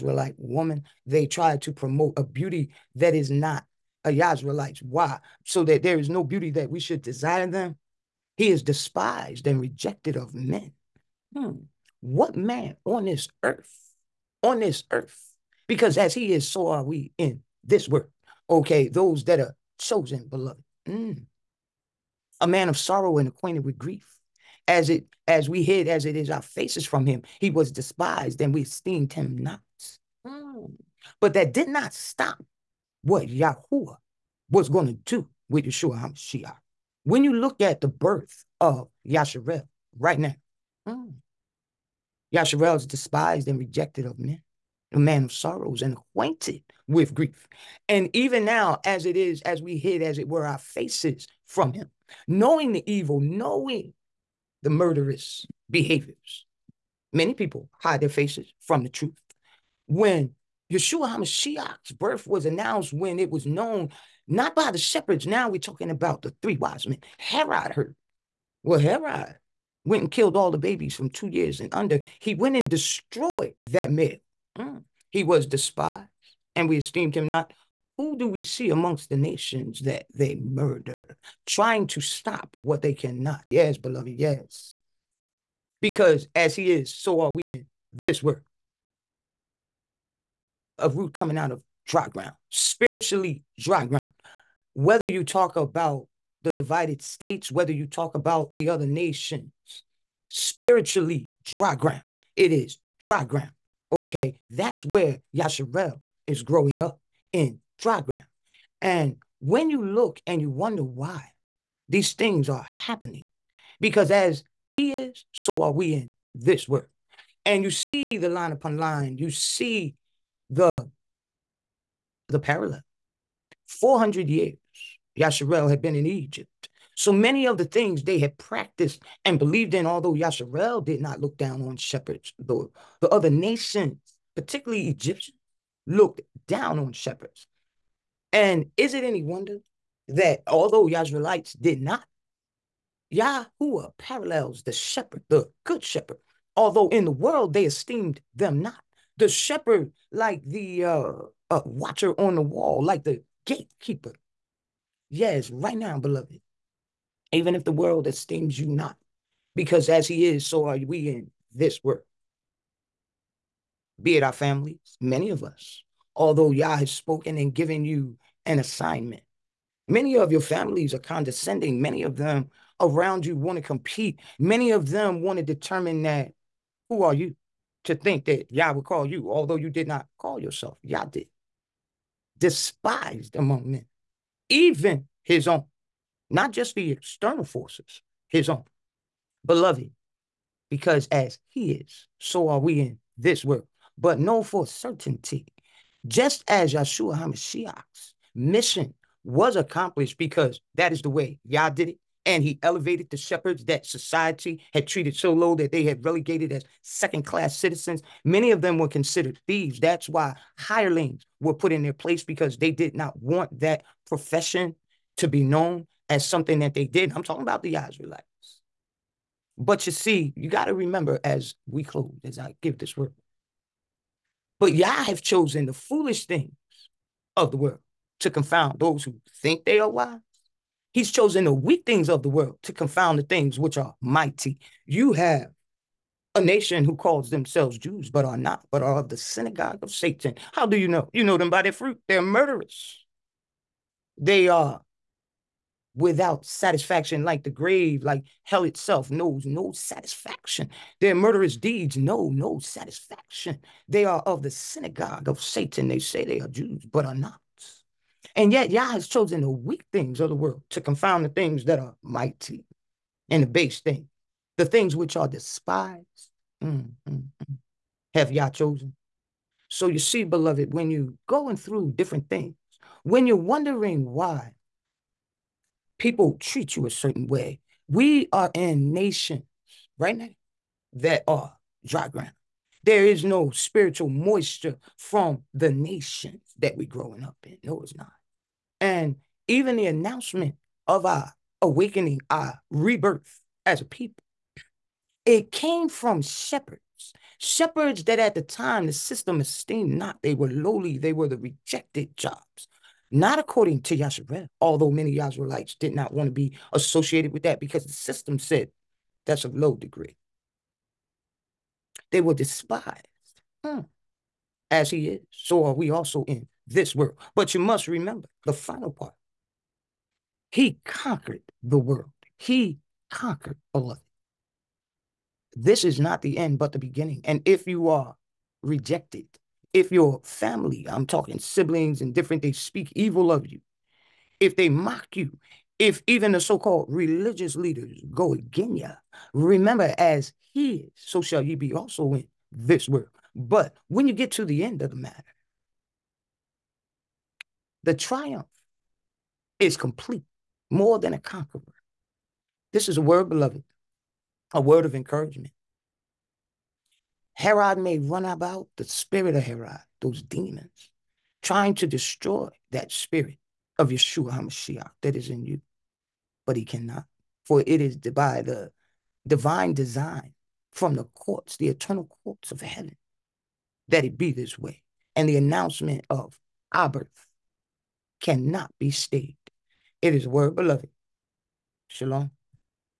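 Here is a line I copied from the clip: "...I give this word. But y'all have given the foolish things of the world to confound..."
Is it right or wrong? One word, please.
wrong.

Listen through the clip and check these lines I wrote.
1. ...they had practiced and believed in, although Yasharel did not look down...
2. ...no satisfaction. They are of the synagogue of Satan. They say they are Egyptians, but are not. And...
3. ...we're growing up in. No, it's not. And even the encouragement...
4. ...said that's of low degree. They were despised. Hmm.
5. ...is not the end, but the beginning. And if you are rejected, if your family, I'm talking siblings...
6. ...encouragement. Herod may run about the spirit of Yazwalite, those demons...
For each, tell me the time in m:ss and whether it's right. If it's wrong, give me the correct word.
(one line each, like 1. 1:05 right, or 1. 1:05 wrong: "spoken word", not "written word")
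1. 2:08 right
2. 4:12 wrong: "Jews", not "Egyptians"
3. 4:46 wrong: "announcement", not "encouragement"
4. 5:08 right
5. 5:25 right
6. 5:54 wrong: "Herod", not "Yazwalite".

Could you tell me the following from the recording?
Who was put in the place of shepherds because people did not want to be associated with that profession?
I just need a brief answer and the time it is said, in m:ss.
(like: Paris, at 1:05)
hirelings, at 3:30.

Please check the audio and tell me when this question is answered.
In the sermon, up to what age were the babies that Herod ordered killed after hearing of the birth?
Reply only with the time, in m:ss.
1:11.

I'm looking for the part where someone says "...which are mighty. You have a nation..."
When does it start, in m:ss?
3:53.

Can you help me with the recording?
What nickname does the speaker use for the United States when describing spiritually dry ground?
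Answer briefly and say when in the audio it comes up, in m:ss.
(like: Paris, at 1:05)
divided states, at 1:36.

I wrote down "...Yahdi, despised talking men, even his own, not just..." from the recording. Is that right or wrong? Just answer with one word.
wrong.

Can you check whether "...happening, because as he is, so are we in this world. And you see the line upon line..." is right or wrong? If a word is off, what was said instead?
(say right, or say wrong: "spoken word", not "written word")
right.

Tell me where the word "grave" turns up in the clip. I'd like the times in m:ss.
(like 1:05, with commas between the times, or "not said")
4:07.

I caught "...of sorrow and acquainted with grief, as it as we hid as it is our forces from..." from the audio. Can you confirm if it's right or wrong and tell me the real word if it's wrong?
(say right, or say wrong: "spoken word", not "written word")
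wrong: "faces", not "forces".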